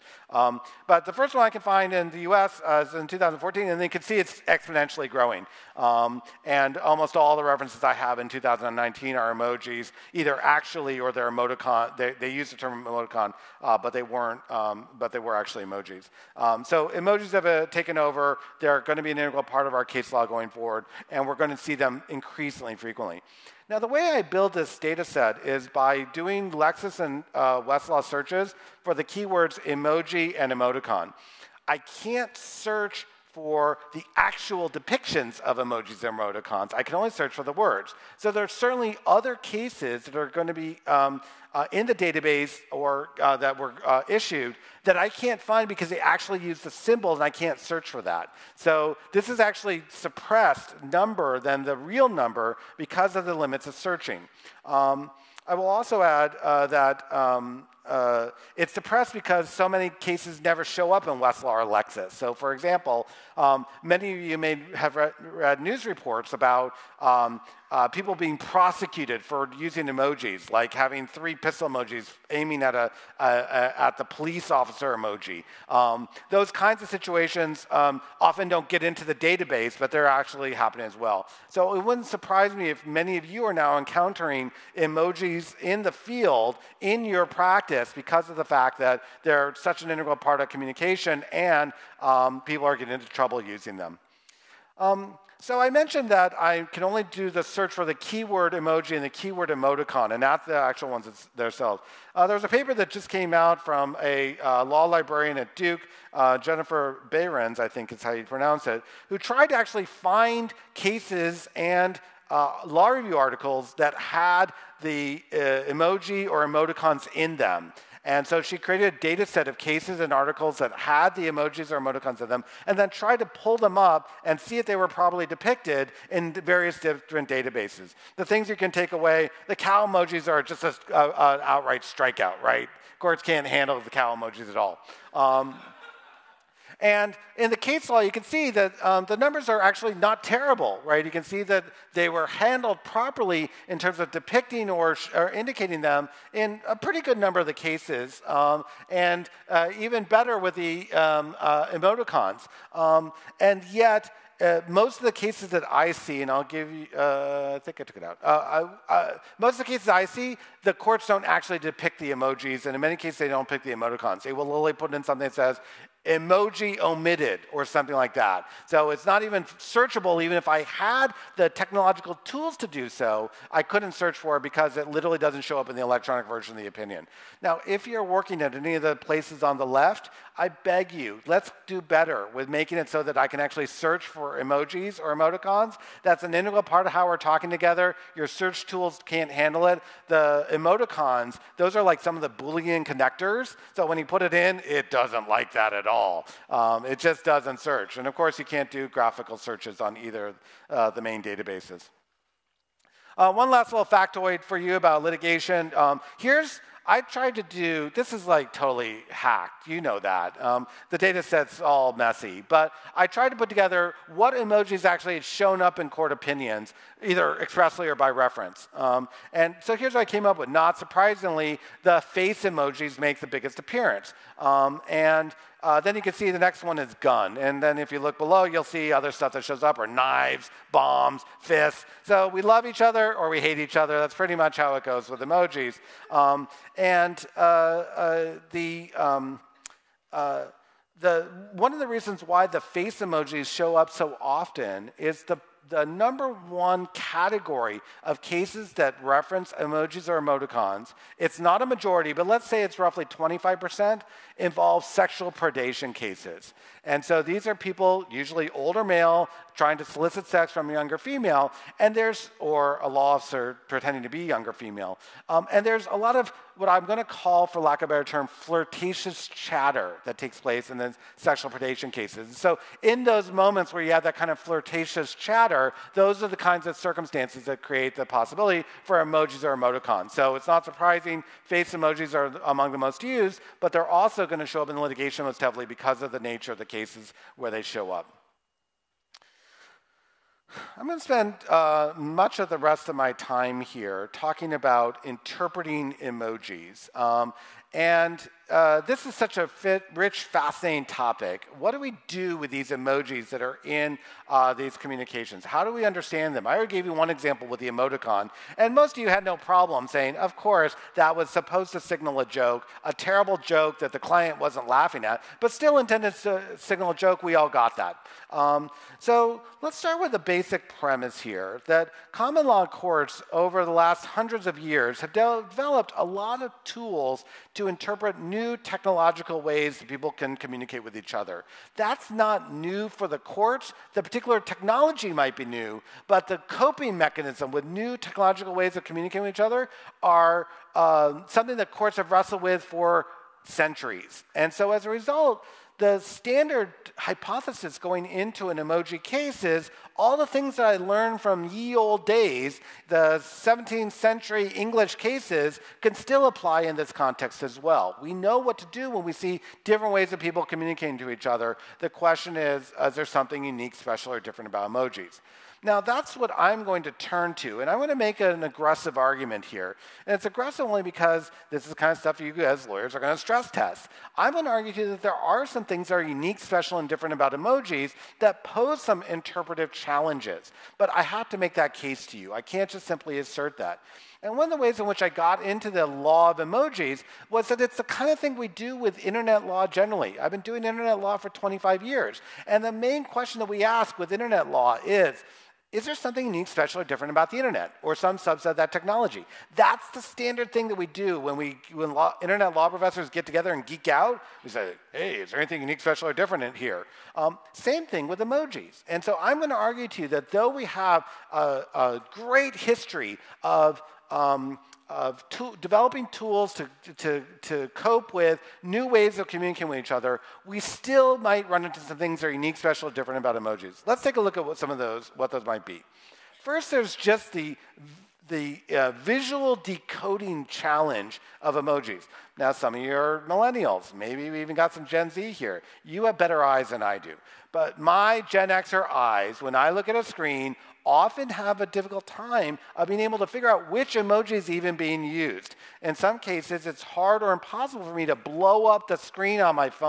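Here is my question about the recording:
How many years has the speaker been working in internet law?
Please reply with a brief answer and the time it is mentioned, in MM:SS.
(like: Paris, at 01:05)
25 years, at 06:31.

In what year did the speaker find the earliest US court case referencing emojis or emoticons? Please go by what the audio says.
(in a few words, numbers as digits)
2014.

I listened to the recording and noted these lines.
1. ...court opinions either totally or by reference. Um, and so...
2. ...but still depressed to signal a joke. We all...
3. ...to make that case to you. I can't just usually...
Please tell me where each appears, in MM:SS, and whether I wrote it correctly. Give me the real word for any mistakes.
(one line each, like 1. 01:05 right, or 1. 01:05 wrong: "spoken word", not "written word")
1. 03:35 wrong: "expressly", not "totally"
2. 05:15 wrong: "intended", not "depressed"
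3. 06:21 wrong: "simply", not "usually".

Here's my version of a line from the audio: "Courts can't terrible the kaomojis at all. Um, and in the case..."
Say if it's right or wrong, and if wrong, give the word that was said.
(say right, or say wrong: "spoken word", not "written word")
wrong: "handle", not "terrible".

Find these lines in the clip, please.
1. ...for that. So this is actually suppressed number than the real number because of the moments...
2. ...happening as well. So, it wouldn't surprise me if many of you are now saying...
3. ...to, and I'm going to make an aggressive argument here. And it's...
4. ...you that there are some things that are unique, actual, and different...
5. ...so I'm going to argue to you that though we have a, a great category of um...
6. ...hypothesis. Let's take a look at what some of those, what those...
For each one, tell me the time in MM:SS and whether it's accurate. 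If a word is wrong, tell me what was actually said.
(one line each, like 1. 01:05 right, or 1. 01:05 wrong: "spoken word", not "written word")
1. 00:47 wrong: "limits", not "moments"
2. 01:20 wrong: "encountering", not "saying"
3. 06:07 right
4. 06:14 wrong: "special", not "actual"
5. 06:49 wrong: "history", not "category"
6. 07:03 wrong: "emojis", not "hypothesis".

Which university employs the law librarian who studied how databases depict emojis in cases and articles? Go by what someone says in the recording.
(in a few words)
Duke.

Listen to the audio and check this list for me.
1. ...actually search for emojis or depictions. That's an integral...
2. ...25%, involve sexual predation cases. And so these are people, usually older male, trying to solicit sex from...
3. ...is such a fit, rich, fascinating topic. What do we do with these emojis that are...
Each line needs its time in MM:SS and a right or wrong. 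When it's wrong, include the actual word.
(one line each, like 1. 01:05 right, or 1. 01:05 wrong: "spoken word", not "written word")
1. 03:03 wrong: "emoticons", not "depictions"
2. 04:13 right
3. 04:59 right.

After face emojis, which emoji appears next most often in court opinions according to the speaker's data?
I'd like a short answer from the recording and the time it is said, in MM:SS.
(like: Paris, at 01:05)
gun, at 03:46.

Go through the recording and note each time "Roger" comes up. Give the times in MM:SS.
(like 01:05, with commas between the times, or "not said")
not said.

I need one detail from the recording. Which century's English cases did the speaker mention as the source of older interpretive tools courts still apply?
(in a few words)
17th century.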